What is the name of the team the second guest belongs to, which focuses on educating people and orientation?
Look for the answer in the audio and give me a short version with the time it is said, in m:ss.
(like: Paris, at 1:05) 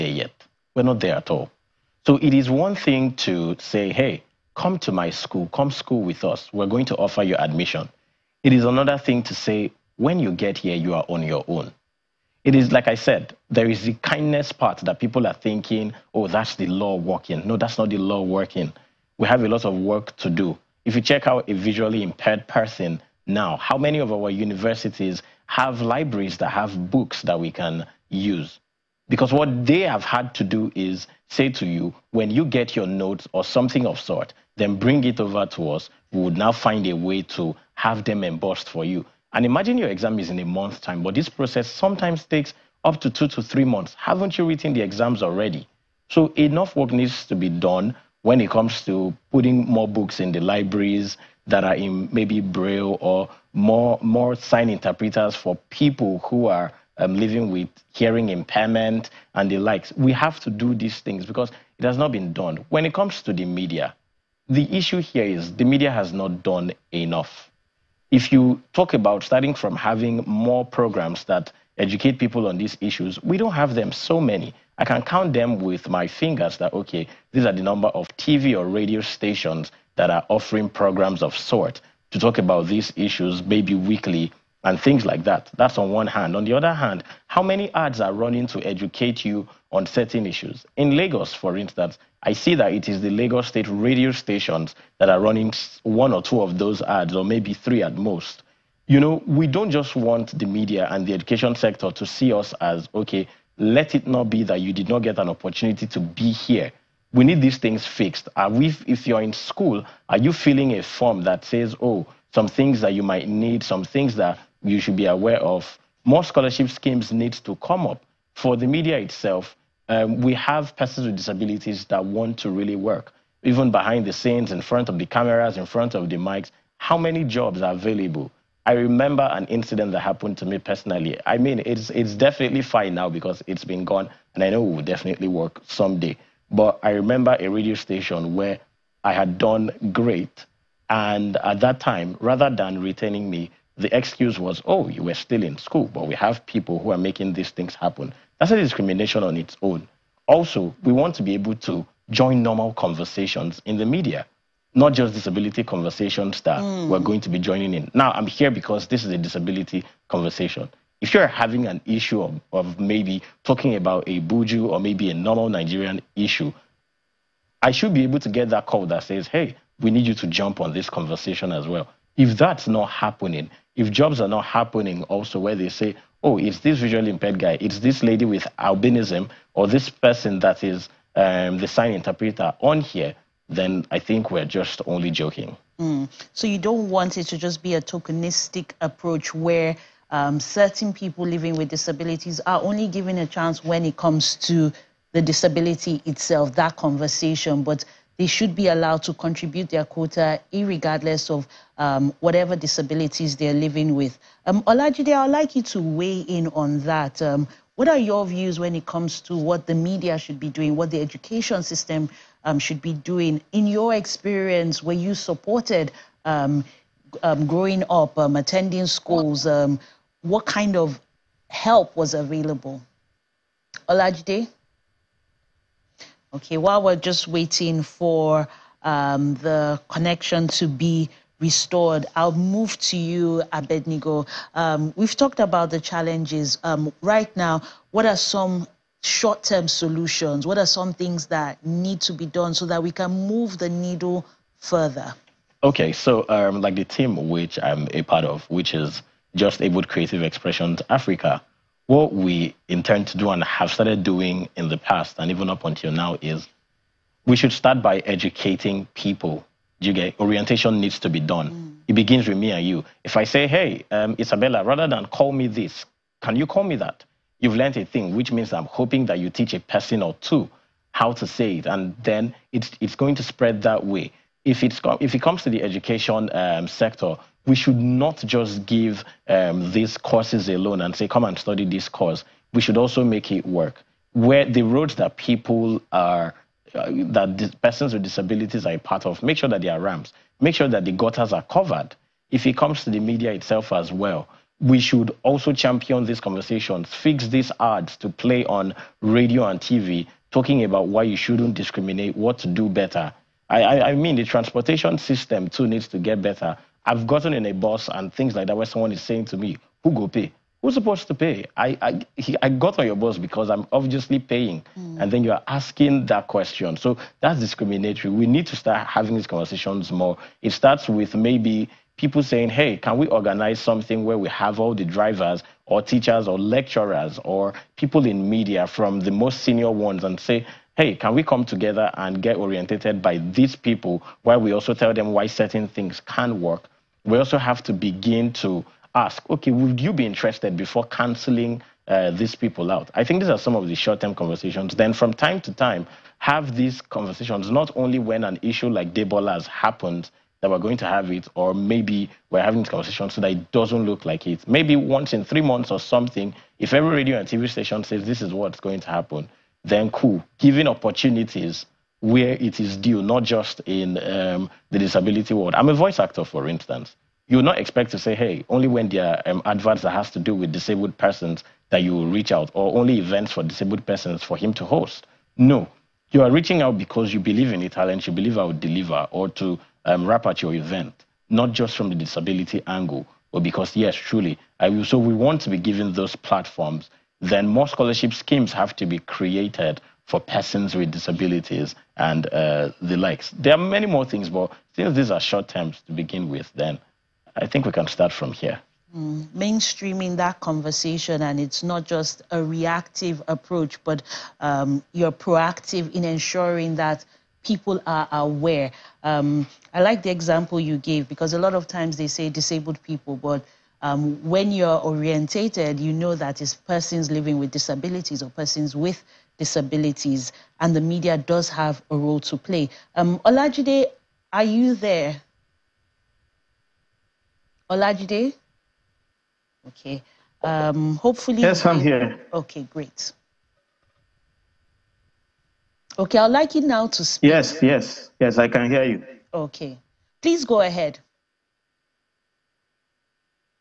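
Just Abled Creative Expressions Africa, at 4:09.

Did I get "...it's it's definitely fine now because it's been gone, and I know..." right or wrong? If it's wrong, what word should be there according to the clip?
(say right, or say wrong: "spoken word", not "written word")
right.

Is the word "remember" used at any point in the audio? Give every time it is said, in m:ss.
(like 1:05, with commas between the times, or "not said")
2:08, 2:16.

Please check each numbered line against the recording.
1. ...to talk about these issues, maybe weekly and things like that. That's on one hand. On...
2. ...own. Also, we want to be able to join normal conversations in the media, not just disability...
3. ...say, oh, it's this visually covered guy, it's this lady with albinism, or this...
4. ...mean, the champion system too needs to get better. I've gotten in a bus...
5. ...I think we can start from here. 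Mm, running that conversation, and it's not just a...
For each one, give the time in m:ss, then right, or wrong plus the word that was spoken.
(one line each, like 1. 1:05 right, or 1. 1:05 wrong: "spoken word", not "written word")
1. 1:22 right
2. 2:29 right
3. 2:55 wrong: "impaired", not "covered"
4. 5:03 wrong: "transportation", not "champion"
5. 6:37 wrong: "mainstreaming", not "running".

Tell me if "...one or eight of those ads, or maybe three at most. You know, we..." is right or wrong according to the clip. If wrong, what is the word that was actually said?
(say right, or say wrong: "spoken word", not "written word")
wrong: "two", not "eight".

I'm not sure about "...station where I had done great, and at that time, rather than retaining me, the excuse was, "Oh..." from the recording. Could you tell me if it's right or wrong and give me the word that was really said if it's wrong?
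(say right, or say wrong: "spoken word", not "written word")
right.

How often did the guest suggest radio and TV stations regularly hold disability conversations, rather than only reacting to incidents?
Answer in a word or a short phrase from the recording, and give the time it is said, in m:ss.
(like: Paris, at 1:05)
Once in 3 months, at 5:54.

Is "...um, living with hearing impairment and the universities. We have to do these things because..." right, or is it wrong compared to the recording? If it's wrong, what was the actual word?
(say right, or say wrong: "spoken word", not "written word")
wrong: "likes", not "universities".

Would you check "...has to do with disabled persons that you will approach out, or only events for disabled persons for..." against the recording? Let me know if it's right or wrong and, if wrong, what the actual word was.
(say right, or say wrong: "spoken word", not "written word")
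wrong: "reach", not "approach".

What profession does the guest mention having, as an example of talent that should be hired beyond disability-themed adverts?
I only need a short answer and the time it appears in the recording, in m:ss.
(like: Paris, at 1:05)
Voice actor, at 6:05.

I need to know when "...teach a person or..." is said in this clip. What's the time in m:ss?
4:29.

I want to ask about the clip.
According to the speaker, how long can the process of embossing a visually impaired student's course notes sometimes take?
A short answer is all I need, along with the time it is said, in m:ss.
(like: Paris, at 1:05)
2 to 3 months, at 0:43.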